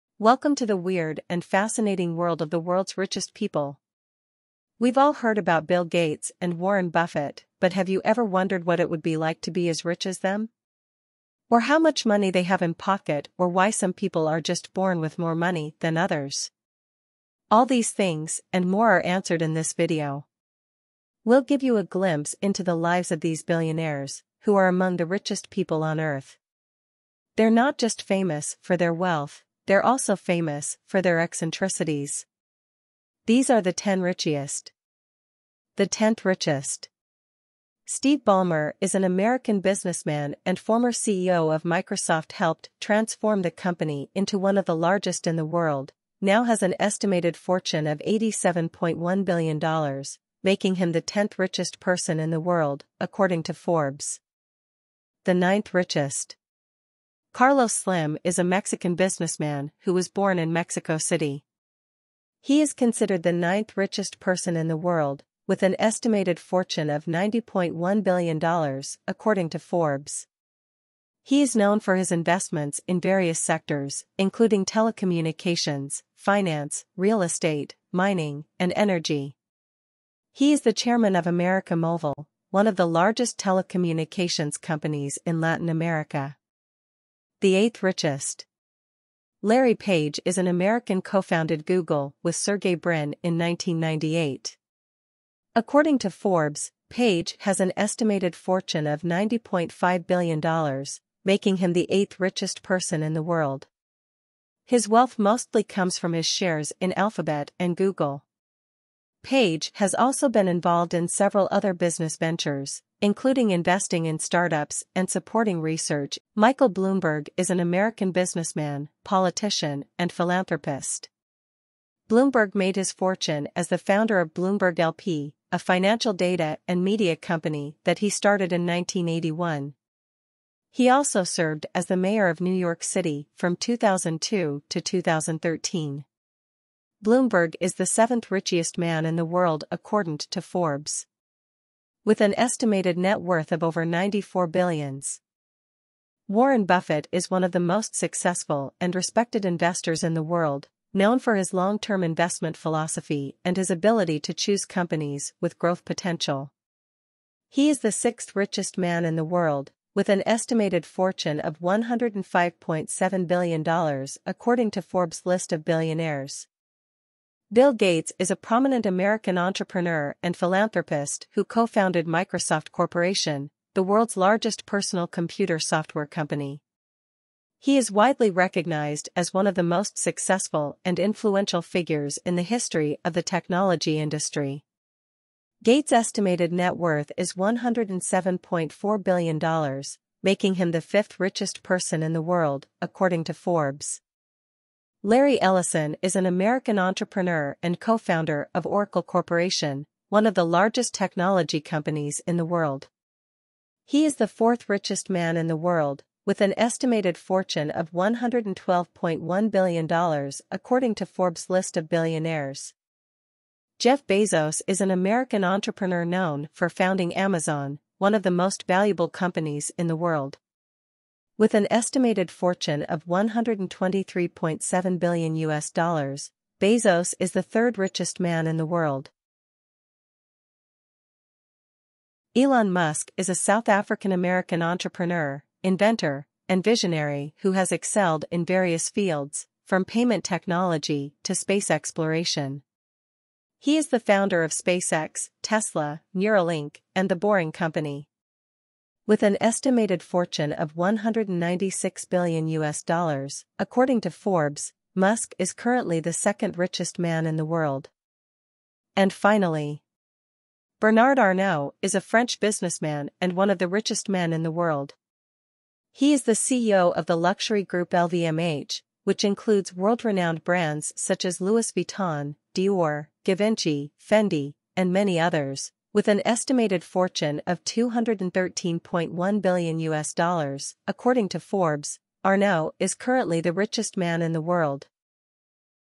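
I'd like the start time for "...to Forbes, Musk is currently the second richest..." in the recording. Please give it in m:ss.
4:14.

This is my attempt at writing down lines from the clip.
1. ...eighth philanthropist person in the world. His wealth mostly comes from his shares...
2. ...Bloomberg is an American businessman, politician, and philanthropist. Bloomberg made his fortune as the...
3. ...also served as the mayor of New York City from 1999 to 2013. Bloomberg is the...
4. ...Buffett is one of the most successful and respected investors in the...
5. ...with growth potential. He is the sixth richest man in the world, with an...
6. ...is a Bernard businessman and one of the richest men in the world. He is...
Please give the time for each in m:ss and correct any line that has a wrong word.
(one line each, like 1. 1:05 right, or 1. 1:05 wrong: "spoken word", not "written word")
1. 1:41 wrong: "richest", not "philanthropist"
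2. 1:56 right
3. 2:10 wrong: "2002", not "1999"
4. 2:26 right
5. 2:35 right
6. 4:21 wrong: "French", not "Bernard".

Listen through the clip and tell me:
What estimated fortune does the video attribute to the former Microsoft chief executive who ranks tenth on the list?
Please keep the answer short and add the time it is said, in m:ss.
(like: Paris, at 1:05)
$87.1 billion, at 0:48.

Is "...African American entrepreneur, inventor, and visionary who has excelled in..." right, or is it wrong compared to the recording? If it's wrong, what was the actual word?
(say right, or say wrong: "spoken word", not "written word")
right.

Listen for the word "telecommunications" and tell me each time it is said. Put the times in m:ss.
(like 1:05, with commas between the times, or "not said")
1:14, 1:23.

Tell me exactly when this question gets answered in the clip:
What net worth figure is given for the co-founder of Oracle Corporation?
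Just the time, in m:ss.
3:27.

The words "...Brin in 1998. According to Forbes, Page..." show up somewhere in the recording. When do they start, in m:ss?
1:32.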